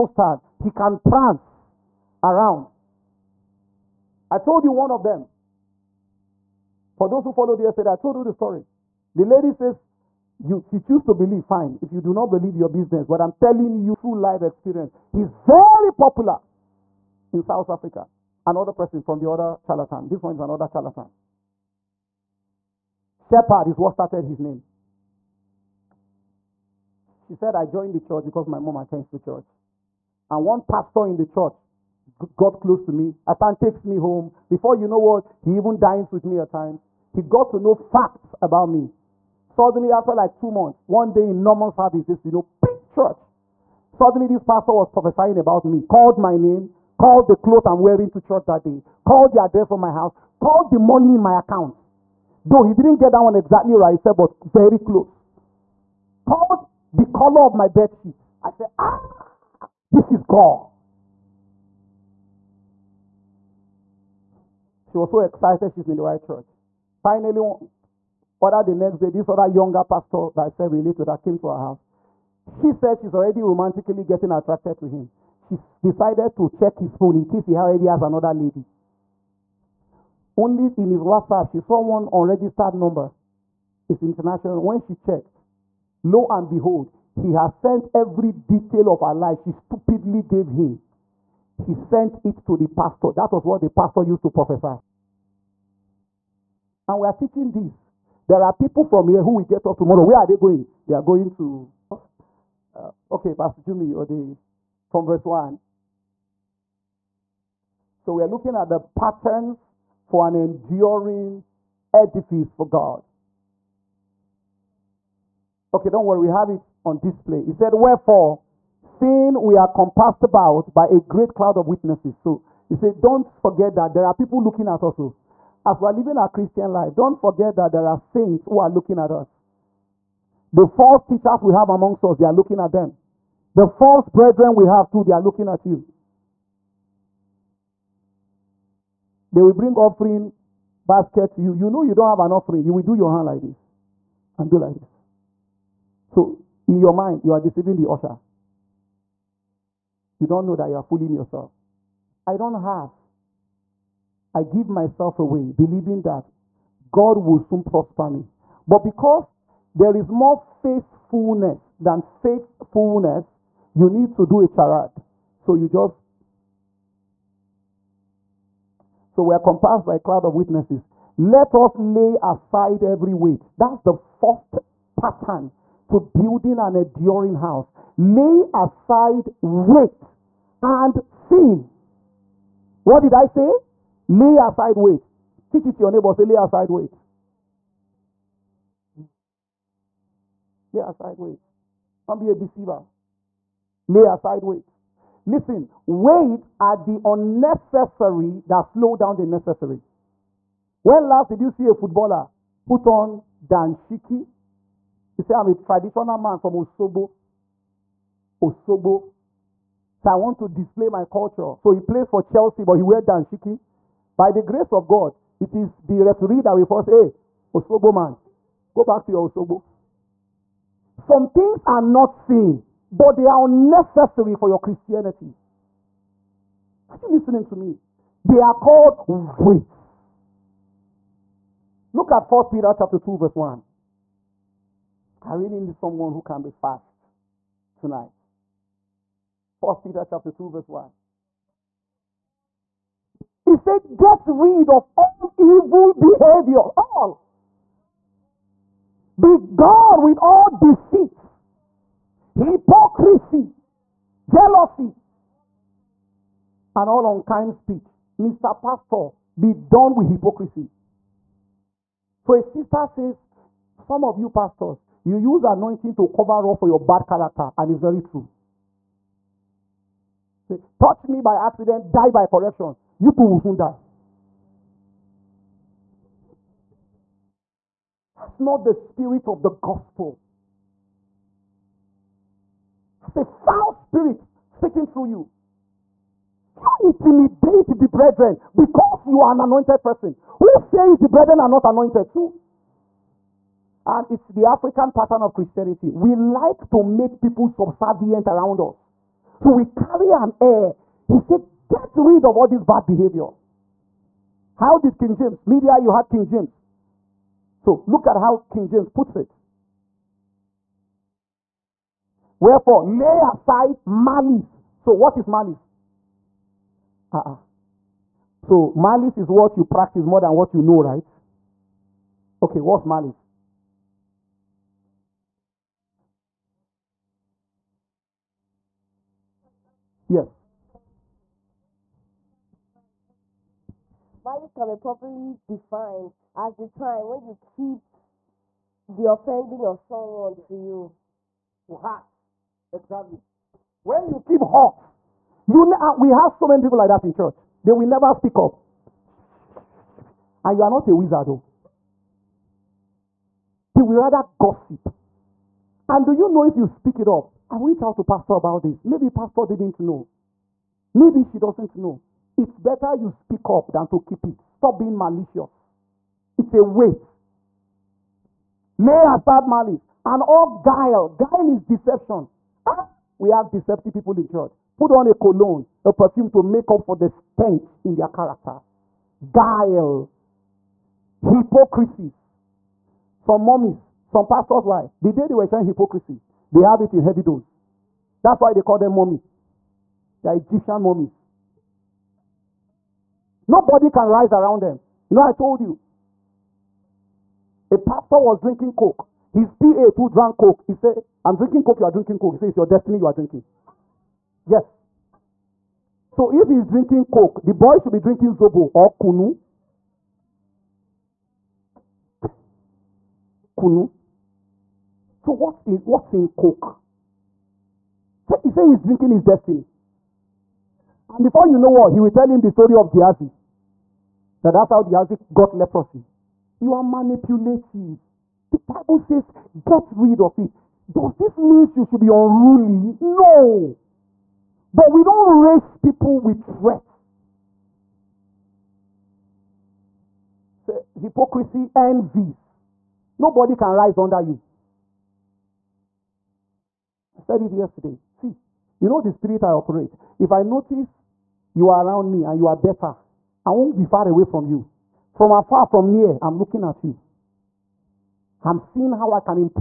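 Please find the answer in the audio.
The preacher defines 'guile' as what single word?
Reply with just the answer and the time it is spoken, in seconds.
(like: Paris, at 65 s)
Deception, at 371 s.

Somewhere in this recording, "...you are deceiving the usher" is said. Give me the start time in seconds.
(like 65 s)
147 s.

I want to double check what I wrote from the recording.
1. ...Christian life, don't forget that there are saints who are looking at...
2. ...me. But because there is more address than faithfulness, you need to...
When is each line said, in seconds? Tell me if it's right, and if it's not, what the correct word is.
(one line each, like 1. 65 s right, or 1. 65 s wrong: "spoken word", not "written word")
1. 126 s right
2. 158 s wrong: "faithfulness", not "address".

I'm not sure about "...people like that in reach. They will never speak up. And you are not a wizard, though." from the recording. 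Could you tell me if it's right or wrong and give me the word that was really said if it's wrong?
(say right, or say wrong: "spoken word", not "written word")
wrong: "church", not "reach".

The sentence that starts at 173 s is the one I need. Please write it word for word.
That's the first pattern to building an enduring house.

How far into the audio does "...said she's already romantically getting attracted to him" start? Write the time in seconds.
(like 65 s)
72 s.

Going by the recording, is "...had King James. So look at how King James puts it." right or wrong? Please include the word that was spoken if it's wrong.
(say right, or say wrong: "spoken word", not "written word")
right.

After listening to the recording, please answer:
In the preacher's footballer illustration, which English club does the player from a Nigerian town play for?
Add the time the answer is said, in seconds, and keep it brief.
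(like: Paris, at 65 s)
Chelsea, at 212 s.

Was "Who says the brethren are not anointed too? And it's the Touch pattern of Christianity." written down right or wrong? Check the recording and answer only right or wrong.
wrong.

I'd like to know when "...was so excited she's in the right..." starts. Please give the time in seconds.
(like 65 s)
64 s.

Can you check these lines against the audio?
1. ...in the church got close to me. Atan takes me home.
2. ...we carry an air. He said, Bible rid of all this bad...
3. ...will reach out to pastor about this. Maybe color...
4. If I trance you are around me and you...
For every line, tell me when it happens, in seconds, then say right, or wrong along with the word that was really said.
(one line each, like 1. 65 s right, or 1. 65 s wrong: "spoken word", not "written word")
1. 31 s right
2. 299 s wrong: "Get", not "Bible"
3. 357 s wrong: "pastor", not "color"
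4. 450 s wrong: "notice", not "trance".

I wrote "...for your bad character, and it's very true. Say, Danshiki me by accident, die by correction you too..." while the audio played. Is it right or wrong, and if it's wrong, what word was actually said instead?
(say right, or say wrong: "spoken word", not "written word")
wrong: "Touch", not "Danshiki".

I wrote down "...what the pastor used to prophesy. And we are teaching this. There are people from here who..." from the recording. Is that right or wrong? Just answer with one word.
right.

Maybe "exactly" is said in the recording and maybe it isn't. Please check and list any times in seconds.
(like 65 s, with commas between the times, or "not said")
53 s, 342 s.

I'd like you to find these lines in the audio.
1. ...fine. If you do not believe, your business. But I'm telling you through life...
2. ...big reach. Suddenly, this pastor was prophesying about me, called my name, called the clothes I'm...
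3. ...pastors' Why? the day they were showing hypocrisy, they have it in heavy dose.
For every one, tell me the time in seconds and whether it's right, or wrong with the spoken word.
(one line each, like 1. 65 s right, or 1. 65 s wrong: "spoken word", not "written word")
1. 11 s right
2. 42 s wrong: "church", not "reach"
3. 384 s right.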